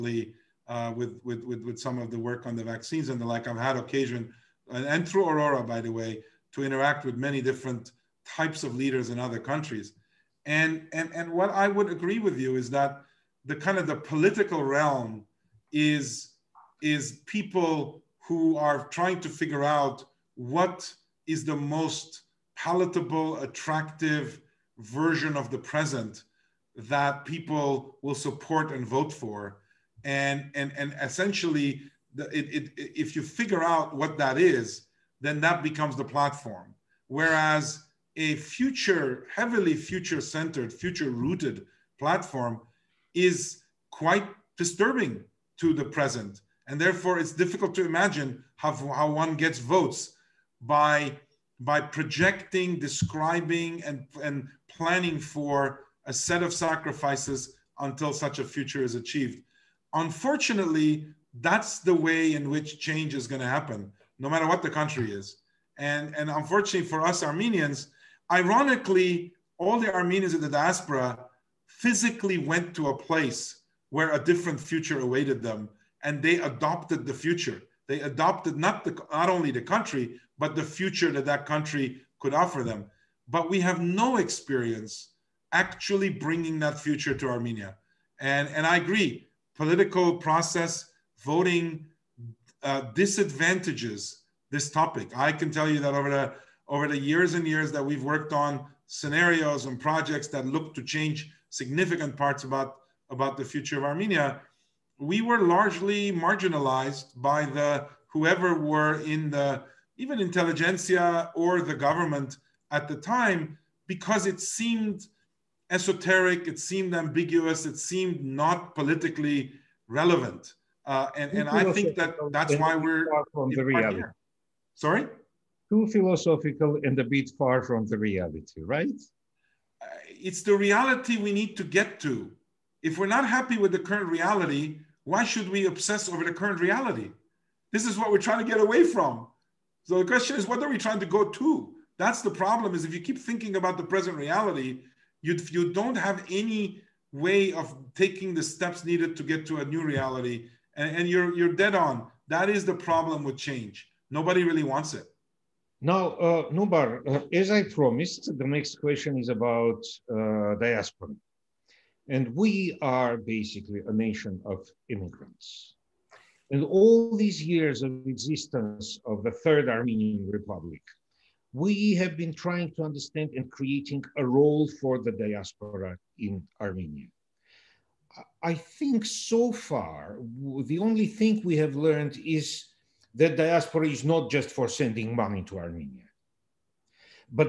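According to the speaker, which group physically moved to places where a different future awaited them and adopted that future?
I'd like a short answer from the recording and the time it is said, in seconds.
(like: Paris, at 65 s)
Armenians in the diaspora, at 69 s.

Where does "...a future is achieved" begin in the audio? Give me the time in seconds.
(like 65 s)
58 s.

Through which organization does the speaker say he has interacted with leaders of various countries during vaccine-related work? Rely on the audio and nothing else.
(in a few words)
Aurora.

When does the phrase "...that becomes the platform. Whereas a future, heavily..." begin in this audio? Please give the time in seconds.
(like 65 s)
35 s.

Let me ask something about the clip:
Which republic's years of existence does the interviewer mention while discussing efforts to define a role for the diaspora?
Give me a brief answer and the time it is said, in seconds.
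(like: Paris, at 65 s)
Third Armenian Republic, at 169 s.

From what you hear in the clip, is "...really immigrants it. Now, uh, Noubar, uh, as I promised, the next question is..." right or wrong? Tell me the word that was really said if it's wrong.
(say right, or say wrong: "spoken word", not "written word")
wrong: "wants", not "immigrants".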